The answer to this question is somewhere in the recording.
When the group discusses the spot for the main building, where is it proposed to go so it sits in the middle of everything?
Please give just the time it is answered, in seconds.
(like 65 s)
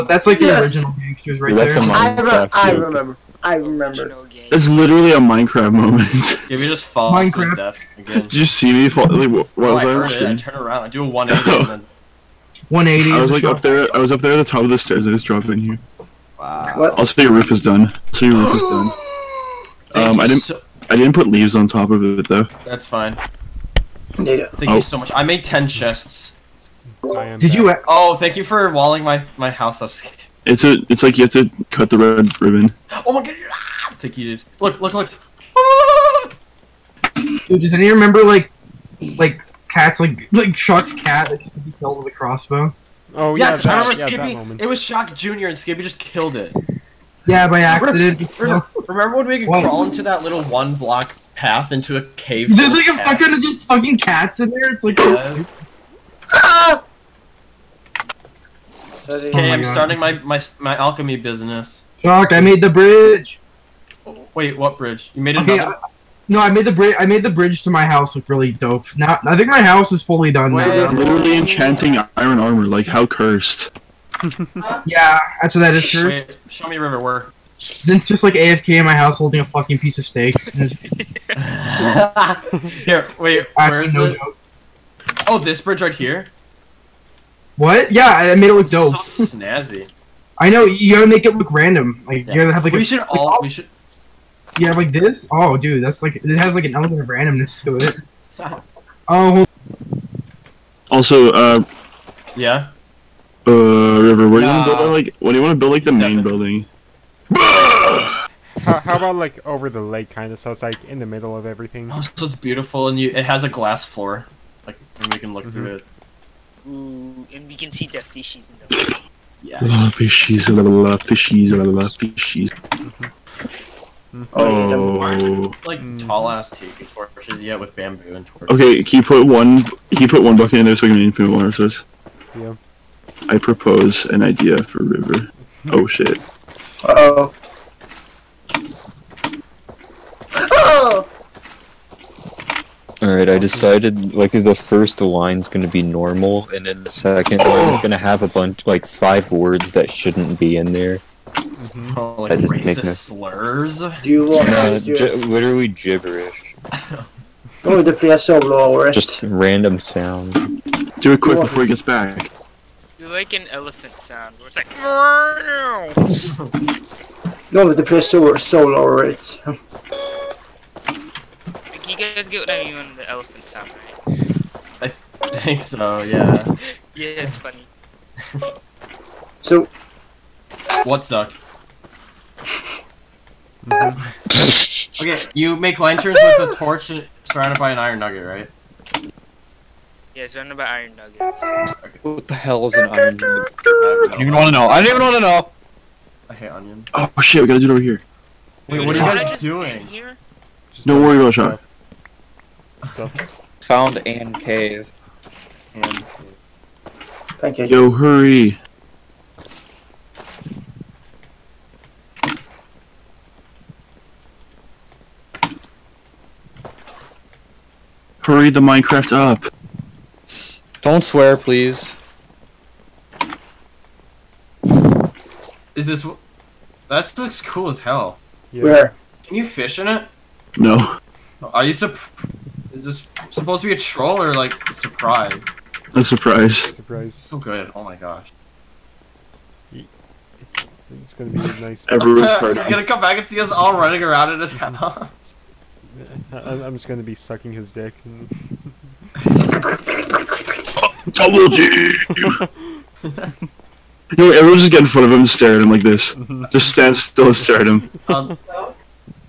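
109 s.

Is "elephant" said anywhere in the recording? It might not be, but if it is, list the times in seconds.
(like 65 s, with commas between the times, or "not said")
163 s, 173 s.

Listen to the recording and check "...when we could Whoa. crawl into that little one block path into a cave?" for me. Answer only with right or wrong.
right.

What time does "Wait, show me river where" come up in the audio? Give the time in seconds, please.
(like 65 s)
76 s.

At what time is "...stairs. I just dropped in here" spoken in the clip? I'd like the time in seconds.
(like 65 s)
14 s.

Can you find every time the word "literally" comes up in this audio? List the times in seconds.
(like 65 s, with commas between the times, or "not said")
4 s, 70 s, 155 s.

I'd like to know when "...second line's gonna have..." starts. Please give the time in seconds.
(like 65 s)
146 s.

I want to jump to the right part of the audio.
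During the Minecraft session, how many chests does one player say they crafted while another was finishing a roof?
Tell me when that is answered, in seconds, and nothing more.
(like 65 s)
25 s.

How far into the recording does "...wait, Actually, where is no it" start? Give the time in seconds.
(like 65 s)
83 s.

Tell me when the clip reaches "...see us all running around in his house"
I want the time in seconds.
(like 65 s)
243 s.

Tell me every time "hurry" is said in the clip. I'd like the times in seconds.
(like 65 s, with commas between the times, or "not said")
207 s, 218 s.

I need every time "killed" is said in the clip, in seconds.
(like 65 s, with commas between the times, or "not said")
41 s, 45 s.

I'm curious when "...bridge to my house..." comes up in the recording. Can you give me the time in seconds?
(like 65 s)
67 s.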